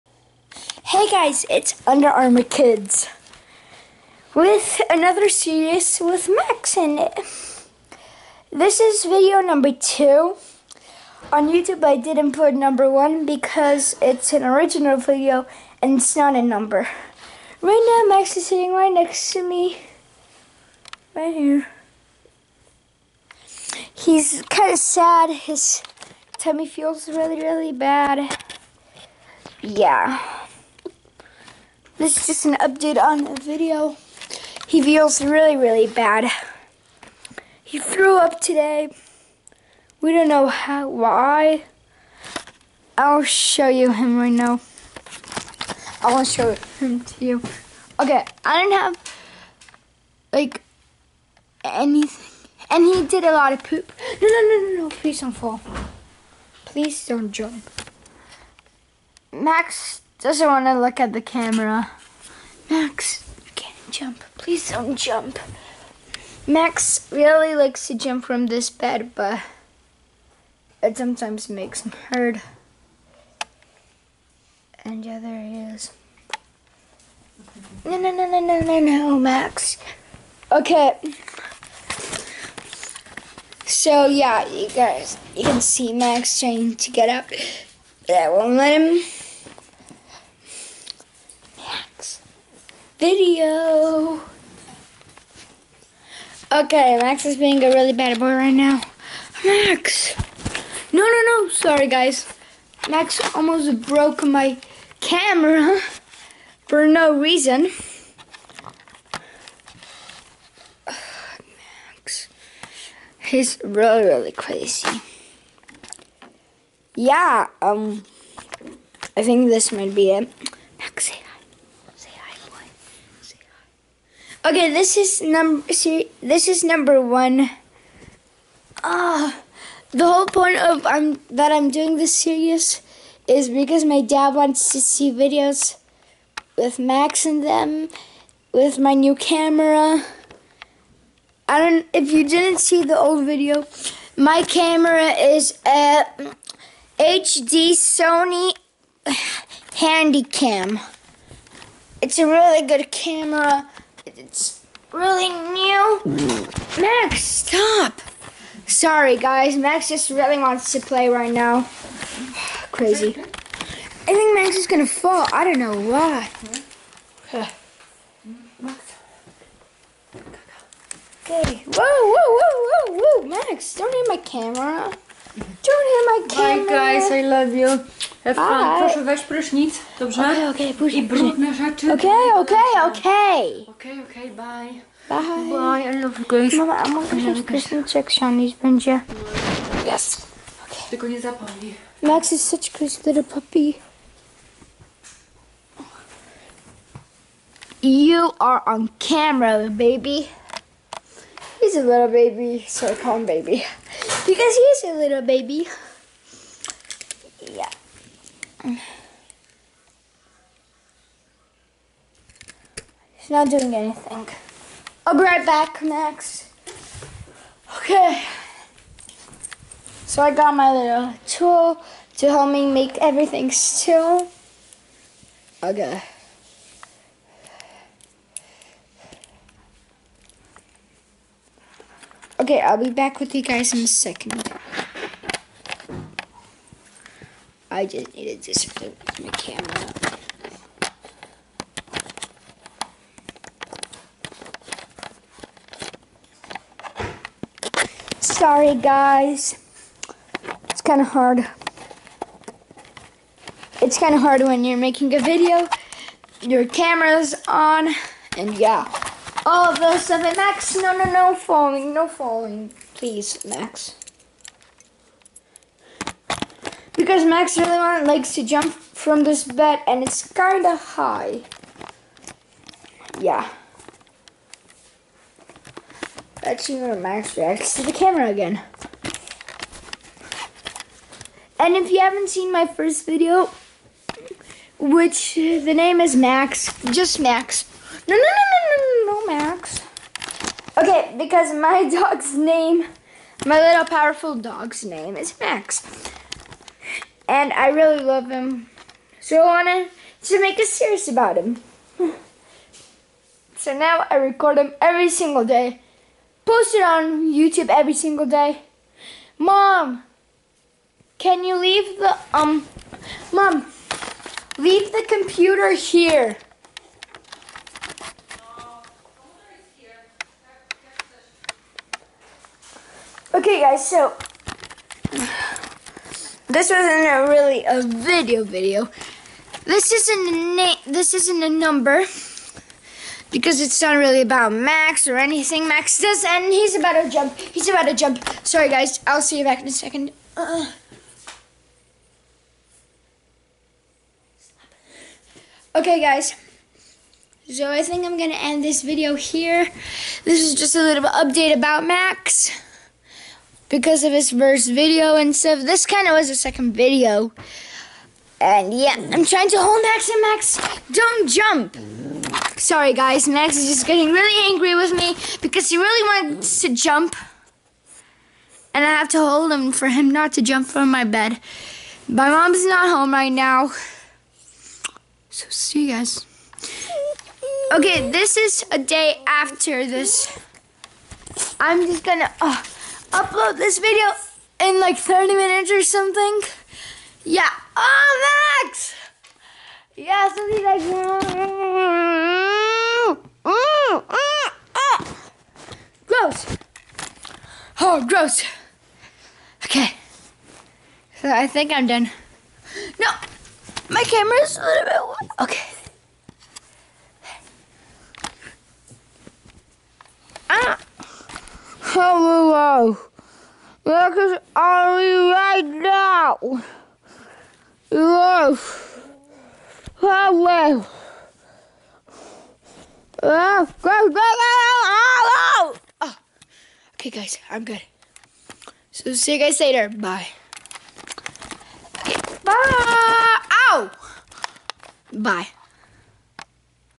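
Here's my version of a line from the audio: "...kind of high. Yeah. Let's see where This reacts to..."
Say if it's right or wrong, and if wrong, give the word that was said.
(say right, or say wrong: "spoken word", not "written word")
wrong: "Max", not "This".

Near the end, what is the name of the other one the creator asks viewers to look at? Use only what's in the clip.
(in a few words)
Ollie.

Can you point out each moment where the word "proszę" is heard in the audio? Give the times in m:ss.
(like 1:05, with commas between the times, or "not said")
2:58.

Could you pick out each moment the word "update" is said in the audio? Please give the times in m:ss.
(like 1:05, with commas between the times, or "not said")
0:32, 5:51.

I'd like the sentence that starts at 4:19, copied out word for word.
All of those stuff, and Max, no, no, no falling, no falling, please, Max.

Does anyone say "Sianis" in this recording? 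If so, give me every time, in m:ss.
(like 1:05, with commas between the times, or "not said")
3:08.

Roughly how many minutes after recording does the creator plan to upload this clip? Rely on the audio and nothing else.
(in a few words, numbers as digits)
30.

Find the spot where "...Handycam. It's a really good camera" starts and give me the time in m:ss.
2:29.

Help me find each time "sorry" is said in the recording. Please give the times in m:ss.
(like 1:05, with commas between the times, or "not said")
1:41, 2:38, 4:08, 5:38, 6:02.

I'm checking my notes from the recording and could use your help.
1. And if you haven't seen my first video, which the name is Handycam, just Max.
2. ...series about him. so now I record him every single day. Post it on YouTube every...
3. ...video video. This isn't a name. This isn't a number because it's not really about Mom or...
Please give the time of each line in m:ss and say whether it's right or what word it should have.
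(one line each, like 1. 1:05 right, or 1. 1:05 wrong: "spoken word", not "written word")
1. 4:41 wrong: "Max", not "Handycam"
2. 5:00 right
3. 5:27 wrong: "Max", not "Mom".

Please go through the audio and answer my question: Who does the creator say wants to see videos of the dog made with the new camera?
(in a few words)
dad.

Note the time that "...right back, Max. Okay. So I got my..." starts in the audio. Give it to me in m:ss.
3:35.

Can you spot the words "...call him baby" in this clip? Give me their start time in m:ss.
3:23.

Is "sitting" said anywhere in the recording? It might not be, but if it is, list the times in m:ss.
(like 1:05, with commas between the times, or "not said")
0:18.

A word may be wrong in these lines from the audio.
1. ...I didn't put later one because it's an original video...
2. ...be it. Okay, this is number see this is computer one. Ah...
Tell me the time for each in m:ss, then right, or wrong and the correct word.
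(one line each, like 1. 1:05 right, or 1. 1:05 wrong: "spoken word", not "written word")
1. 0:11 wrong: "number", not "later"
2. 1:59 wrong: "number", not "computer".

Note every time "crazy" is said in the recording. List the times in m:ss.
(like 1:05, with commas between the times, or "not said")
1:54, 2:42, 3:12.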